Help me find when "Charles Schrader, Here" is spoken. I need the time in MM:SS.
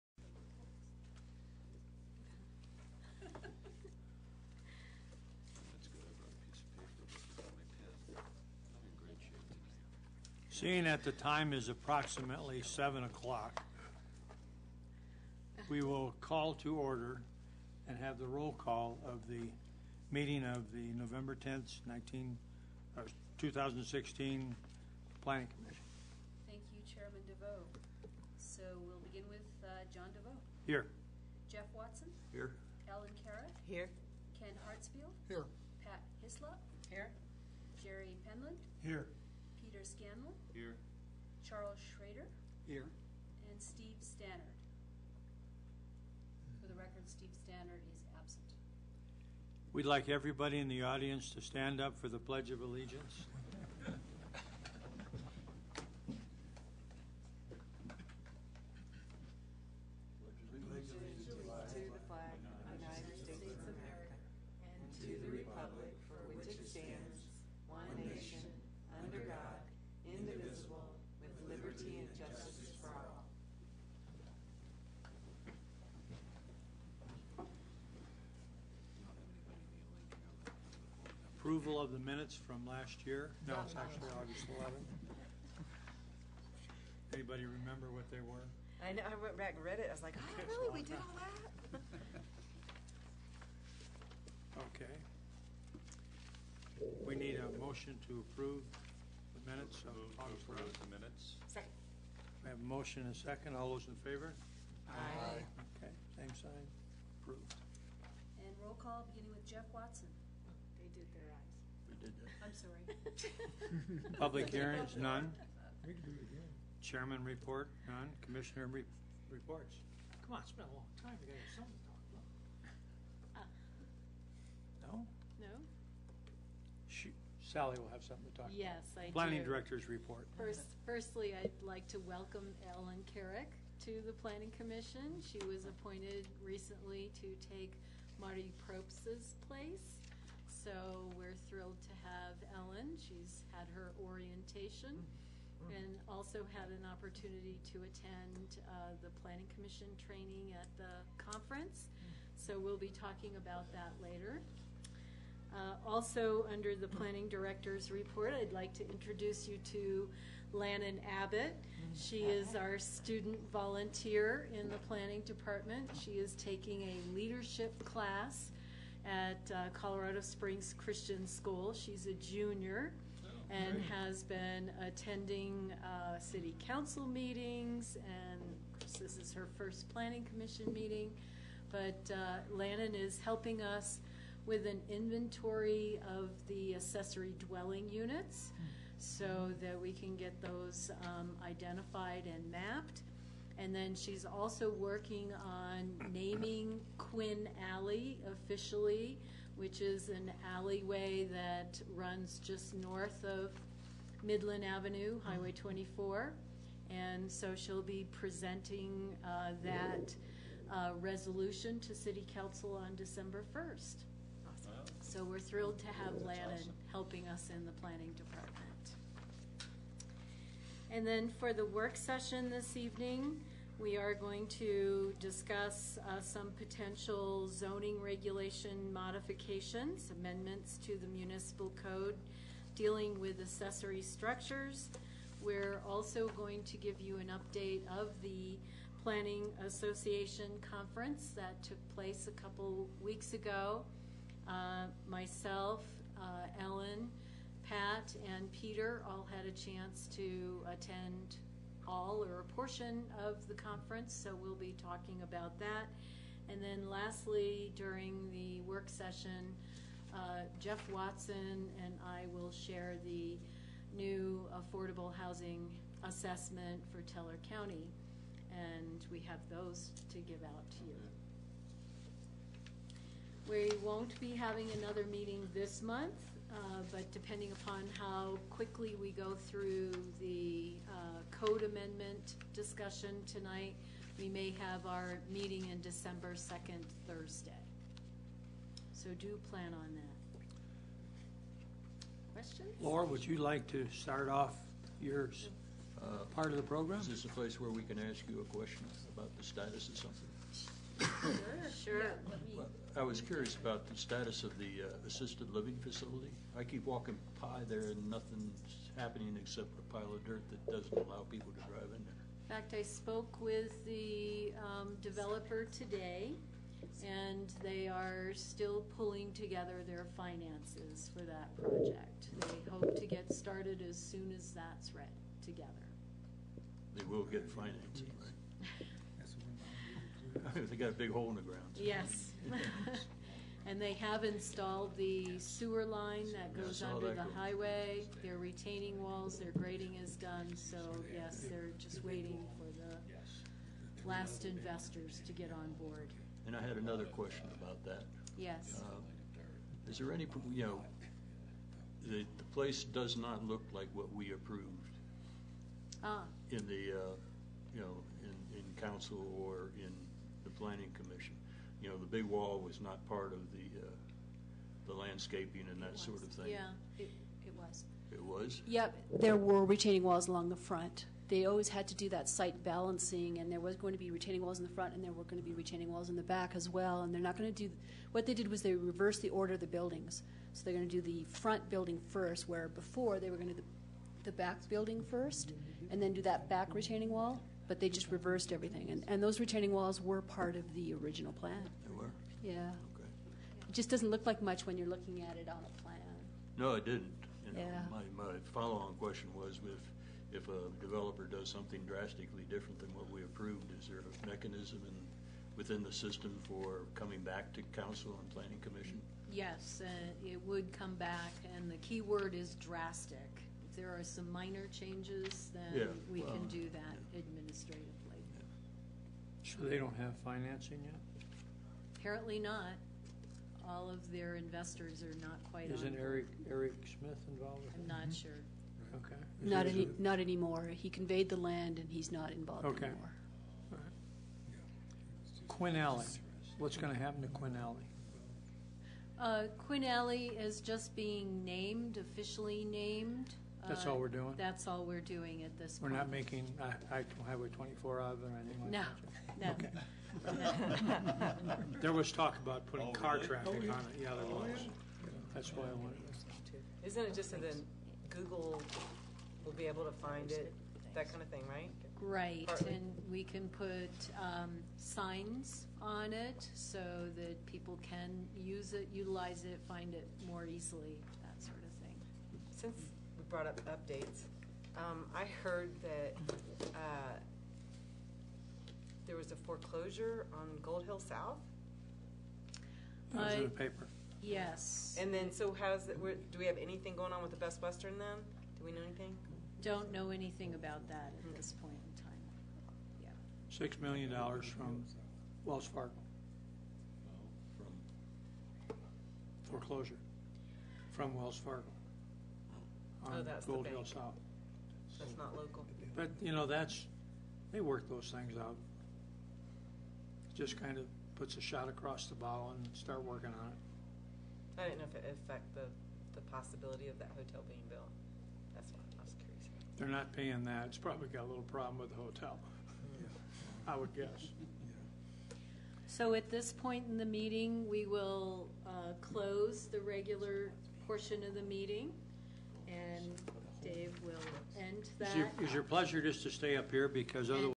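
00:41.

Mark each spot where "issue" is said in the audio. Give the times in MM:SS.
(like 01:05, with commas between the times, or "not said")
not said.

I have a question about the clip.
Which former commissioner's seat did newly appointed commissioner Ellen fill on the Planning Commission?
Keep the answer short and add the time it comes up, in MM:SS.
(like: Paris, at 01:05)
Marty Props, at 02:18.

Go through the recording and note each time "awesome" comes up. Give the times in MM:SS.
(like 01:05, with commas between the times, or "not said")
03:36.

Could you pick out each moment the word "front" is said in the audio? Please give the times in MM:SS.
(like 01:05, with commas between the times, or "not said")
06:10, 06:14, 06:21.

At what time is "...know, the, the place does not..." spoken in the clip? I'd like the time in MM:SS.
05:50.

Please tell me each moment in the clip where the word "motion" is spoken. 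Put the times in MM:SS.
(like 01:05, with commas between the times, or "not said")
01:37, 01:42.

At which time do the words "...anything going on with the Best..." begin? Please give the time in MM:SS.
08:06.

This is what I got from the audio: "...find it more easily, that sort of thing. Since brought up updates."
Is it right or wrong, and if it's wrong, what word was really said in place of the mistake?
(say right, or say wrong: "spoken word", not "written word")
right.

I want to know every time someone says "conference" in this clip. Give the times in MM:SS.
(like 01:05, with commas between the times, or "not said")
02:31, 04:00, 04:13.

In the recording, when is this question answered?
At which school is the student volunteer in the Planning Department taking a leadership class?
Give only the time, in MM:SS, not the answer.
02:49.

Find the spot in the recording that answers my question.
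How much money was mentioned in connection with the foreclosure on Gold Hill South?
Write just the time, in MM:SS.
08:13.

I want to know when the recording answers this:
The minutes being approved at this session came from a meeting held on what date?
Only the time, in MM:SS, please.
01:24.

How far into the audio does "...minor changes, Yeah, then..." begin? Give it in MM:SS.
06:54.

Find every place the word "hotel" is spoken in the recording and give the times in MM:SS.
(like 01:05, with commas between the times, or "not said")
08:37, 08:42.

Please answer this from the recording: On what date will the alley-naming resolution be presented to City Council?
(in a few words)
December 1st.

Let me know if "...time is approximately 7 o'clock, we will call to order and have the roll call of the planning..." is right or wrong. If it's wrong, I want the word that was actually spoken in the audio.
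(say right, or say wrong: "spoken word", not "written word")
wrong: "meeting", not "planning".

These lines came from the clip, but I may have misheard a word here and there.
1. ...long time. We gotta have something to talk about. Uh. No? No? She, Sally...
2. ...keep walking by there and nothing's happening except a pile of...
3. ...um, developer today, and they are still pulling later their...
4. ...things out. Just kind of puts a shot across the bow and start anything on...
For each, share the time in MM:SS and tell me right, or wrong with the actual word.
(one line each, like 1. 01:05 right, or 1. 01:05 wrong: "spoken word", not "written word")
1. 02:00 right
2. 05:06 right
3. 05:14 wrong: "together", not "later"
4. 08:28 wrong: "working", not "anything".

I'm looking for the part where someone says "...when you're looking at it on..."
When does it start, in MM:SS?
06:34.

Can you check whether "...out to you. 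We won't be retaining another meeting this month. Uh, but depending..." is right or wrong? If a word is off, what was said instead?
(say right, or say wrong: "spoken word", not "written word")
wrong: "having", not "retaining".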